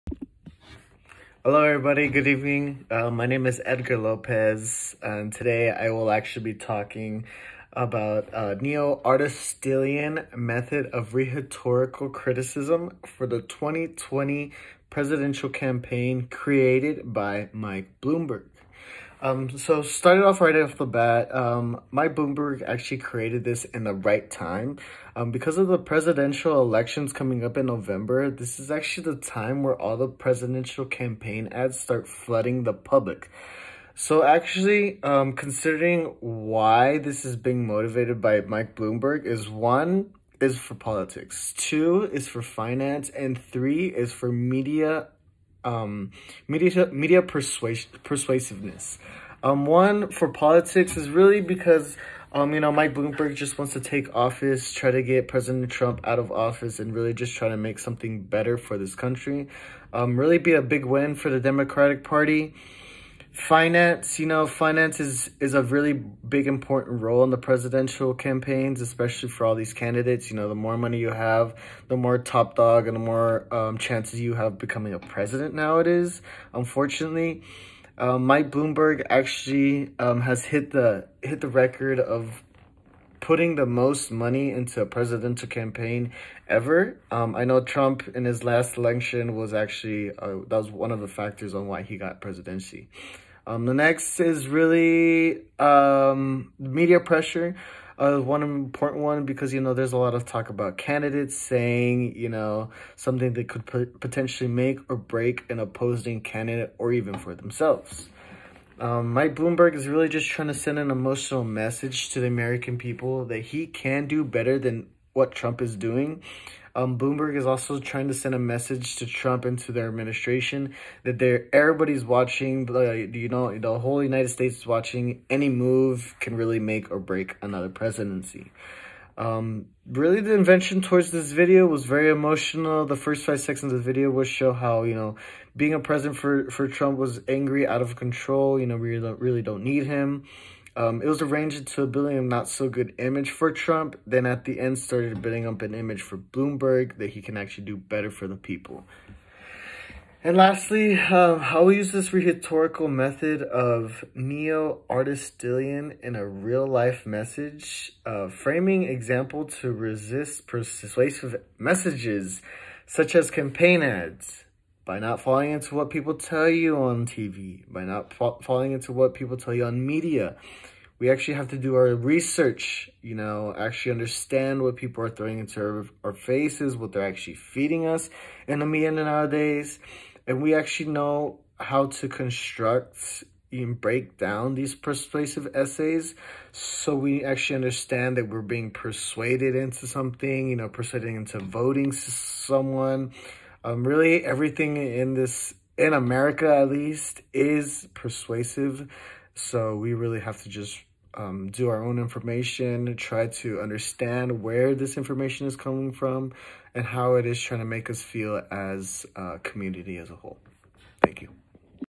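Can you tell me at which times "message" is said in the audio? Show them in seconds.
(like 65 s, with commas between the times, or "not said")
111 s, 118 s, 157 s, 161 s.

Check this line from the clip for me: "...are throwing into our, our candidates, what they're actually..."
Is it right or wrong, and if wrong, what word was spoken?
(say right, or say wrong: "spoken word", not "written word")
wrong: "faces", not "candidates".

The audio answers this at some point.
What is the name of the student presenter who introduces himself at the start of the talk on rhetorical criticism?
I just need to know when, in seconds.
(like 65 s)
3 s.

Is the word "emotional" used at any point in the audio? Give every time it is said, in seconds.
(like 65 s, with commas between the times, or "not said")
110 s, 132 s.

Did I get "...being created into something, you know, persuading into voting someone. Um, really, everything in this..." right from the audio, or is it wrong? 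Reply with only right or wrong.
wrong.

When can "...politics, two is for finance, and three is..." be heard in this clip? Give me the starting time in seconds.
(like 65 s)
40 s.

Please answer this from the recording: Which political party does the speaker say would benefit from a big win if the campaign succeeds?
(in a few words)
Democratic Party.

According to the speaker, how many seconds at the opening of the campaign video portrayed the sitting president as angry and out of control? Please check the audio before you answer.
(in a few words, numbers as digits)
5.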